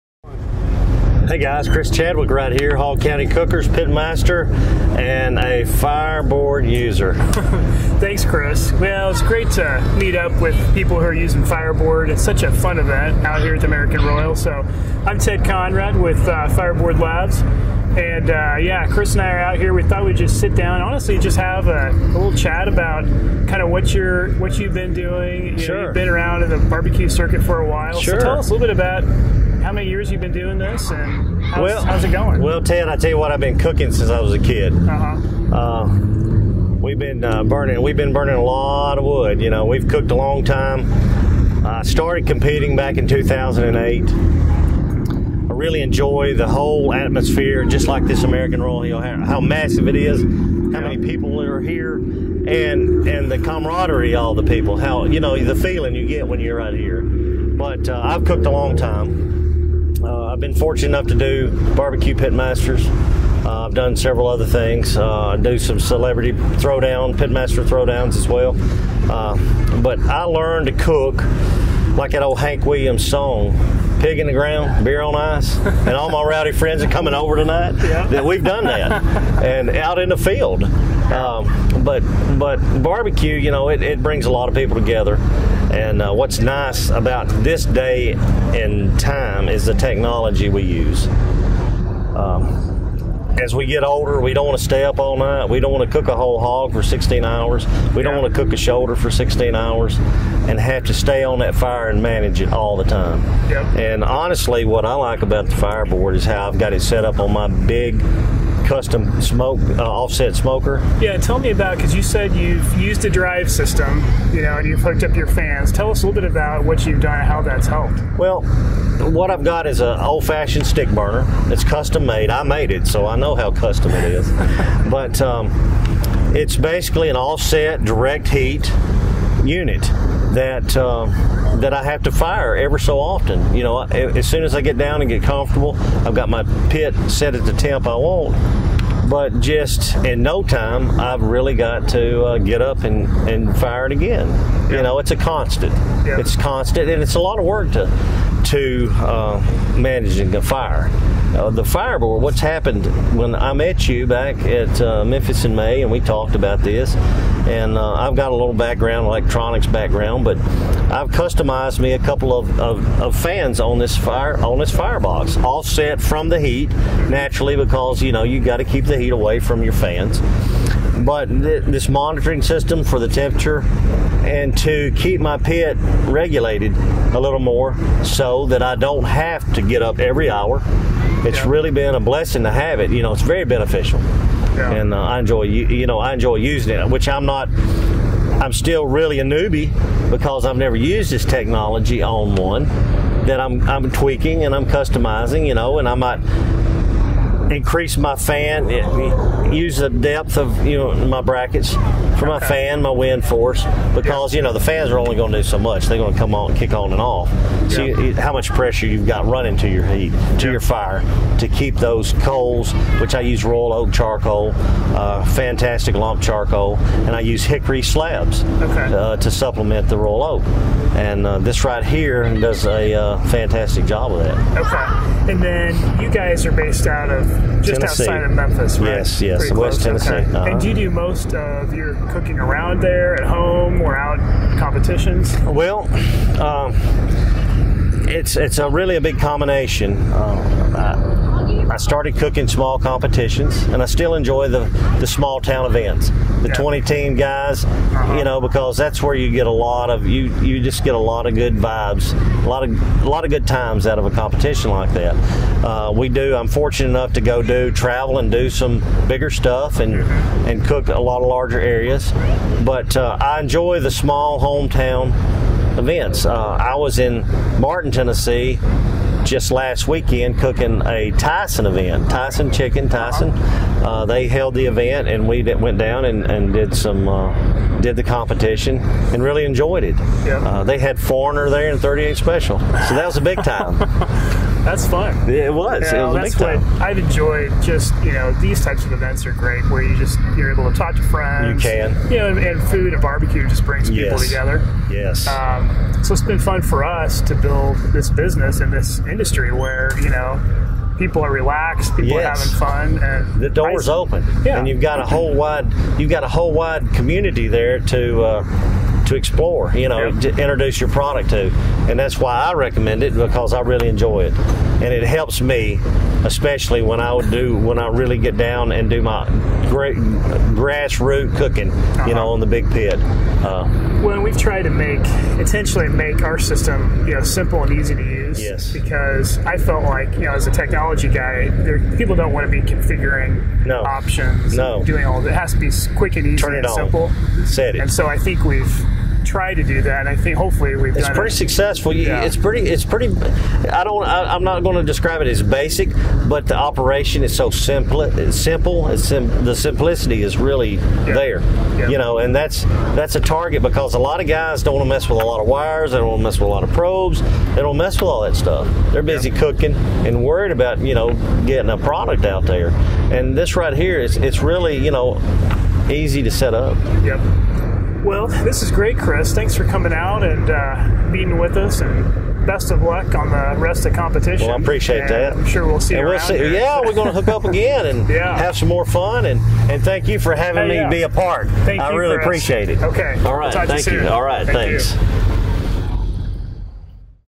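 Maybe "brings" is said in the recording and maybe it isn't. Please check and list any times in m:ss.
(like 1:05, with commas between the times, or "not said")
1:24, 4:53.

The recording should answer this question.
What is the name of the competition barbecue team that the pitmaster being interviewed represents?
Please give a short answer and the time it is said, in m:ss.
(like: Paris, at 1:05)
Hall County Cookers, at 0:02.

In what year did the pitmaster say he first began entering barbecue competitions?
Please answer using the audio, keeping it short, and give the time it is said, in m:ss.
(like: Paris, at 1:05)
2008, at 0:43.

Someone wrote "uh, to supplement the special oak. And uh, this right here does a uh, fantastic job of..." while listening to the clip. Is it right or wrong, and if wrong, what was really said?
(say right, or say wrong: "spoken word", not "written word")
wrong: "royal", not "special".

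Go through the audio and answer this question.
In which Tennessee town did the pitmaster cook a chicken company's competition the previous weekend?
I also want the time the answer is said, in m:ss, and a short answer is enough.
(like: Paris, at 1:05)
Martin, at 4:27.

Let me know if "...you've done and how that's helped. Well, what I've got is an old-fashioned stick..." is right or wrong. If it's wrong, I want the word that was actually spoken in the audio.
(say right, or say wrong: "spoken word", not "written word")
right.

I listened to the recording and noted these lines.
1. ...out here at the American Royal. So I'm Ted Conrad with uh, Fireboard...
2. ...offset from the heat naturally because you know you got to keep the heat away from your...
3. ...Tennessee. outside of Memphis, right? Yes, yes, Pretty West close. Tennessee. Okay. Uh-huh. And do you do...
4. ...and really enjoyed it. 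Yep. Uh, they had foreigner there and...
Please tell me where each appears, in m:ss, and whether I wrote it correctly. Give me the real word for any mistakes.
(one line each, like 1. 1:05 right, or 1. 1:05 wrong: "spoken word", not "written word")
1. 0:13 right
2. 2:45 right
3. 3:47 right
4. 4:38 right.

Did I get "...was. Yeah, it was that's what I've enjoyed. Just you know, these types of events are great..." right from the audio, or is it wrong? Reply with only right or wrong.
right.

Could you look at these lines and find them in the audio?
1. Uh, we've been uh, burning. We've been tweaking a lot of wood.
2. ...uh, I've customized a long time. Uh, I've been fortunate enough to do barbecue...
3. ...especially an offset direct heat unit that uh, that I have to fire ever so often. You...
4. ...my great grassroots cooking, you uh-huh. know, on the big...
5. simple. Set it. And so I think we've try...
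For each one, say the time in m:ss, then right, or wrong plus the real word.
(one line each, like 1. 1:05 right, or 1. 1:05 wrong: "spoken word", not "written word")
1. 0:35 wrong: "burning", not "tweaking"
2. 0:57 wrong: "cooked", not "customized"
3. 2:06 wrong: "basically", not "especially"
4. 5:19 right
5. 5:36 right.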